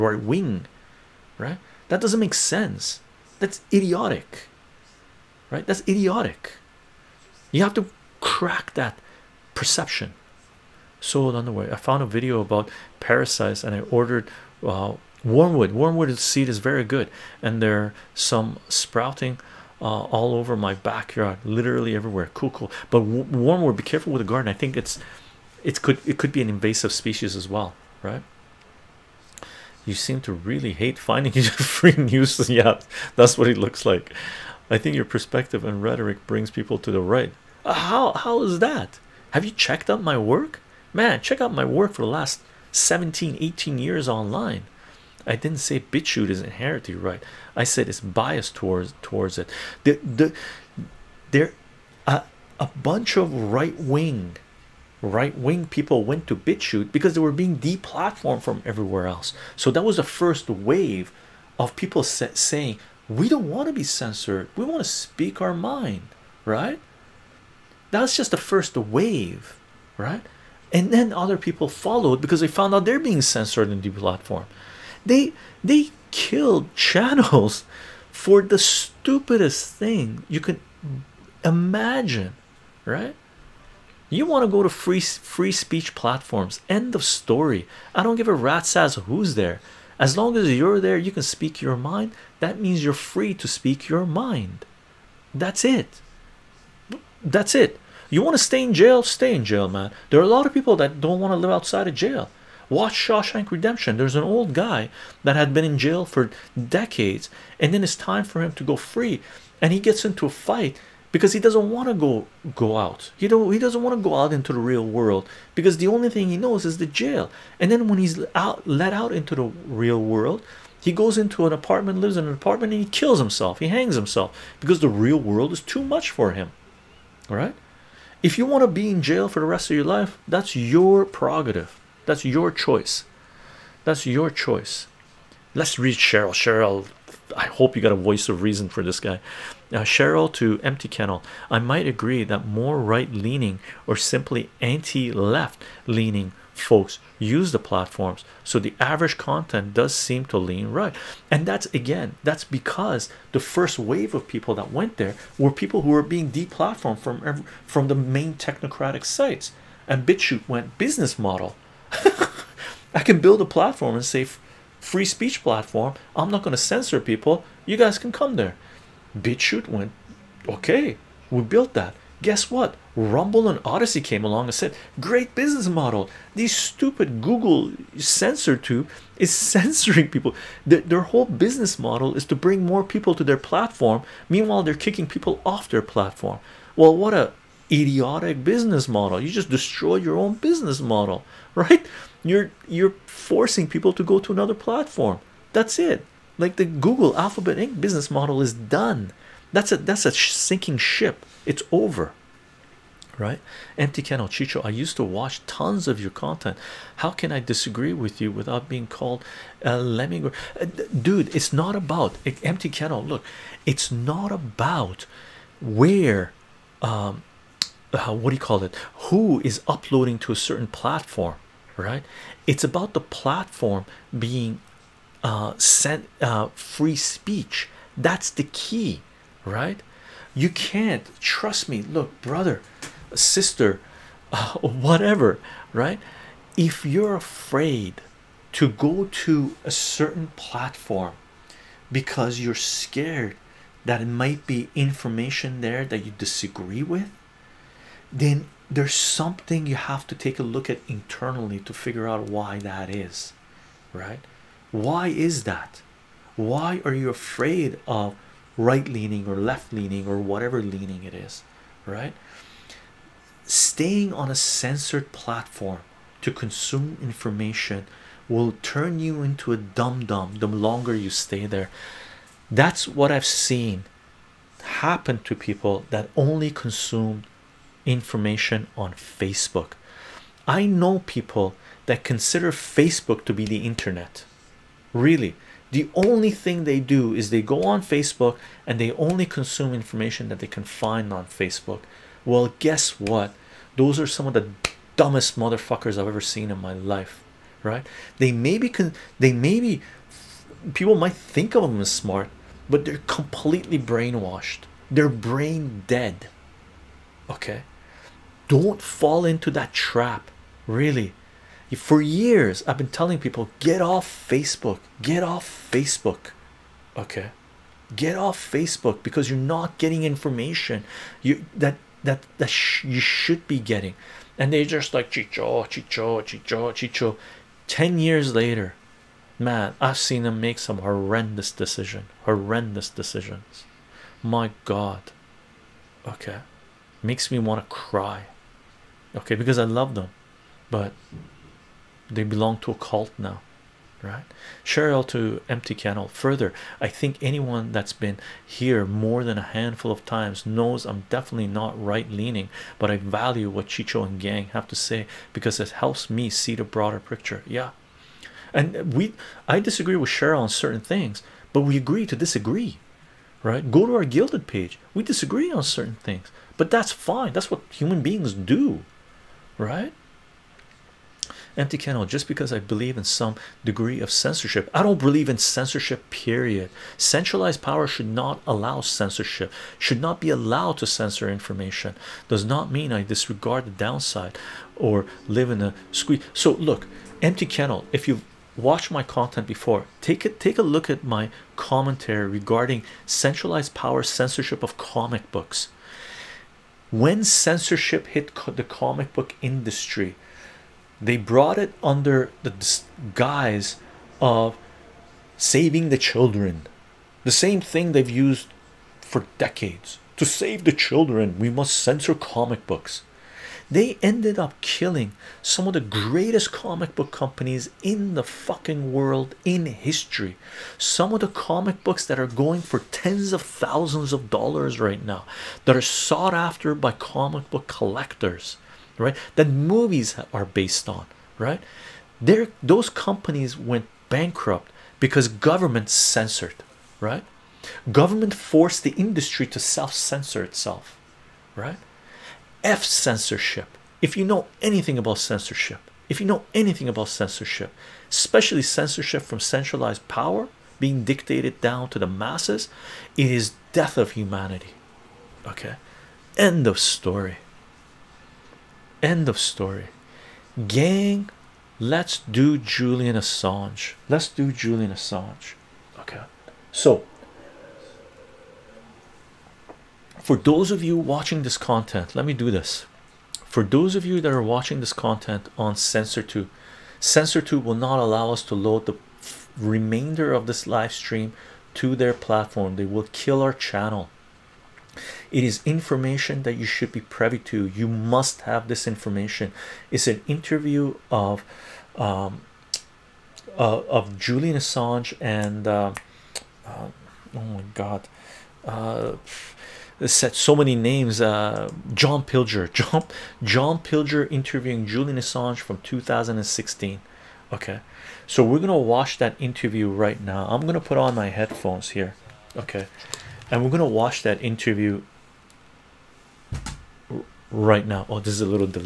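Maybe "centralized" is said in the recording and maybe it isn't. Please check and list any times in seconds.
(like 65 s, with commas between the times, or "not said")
376 s, 393 s, 449 s.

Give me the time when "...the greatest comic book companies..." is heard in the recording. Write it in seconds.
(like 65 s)
415 s.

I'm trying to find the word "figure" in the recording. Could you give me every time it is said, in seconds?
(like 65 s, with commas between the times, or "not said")
251 s.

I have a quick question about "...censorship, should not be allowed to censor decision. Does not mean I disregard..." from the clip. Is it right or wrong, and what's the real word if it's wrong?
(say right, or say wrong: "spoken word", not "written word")
wrong: "information", not "decision".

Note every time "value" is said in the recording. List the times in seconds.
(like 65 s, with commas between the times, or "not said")
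352 s.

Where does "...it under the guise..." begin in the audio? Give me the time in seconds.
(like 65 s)
401 s.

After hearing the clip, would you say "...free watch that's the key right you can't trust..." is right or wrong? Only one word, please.
wrong.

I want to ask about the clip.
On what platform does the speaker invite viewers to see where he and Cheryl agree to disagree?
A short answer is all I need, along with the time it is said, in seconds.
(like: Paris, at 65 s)
Guilded, at 364 s.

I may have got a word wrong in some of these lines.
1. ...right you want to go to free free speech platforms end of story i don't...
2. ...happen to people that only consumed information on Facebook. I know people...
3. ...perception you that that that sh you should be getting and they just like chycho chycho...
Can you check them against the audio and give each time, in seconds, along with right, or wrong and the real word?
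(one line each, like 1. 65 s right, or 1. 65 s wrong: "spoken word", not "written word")
1. 82 s right
2. 274 s right
3. 320 s wrong: "information", not "perception".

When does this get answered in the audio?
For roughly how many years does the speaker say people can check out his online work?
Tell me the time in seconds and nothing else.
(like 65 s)
42 s.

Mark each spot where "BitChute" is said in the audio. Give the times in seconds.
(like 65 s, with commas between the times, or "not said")
45 s, 56 s, 160 s, 169 s.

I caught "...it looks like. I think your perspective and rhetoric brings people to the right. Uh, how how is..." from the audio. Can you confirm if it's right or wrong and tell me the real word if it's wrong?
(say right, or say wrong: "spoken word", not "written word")
right.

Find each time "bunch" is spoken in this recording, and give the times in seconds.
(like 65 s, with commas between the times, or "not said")
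52 s.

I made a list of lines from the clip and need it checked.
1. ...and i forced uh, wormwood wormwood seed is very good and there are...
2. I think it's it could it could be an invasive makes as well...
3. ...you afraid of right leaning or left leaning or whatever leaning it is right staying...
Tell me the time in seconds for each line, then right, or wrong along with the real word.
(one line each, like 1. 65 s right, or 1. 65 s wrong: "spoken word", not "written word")
1. 13 s wrong: "ordered", not "forced"
2. 24 s wrong: "species", not "makes"
3. 256 s right.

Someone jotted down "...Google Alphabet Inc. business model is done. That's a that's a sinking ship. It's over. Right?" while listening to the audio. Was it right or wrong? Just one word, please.
right.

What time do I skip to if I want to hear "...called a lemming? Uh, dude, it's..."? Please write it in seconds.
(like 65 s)
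208 s.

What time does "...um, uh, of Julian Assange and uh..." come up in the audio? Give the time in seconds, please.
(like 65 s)
491 s.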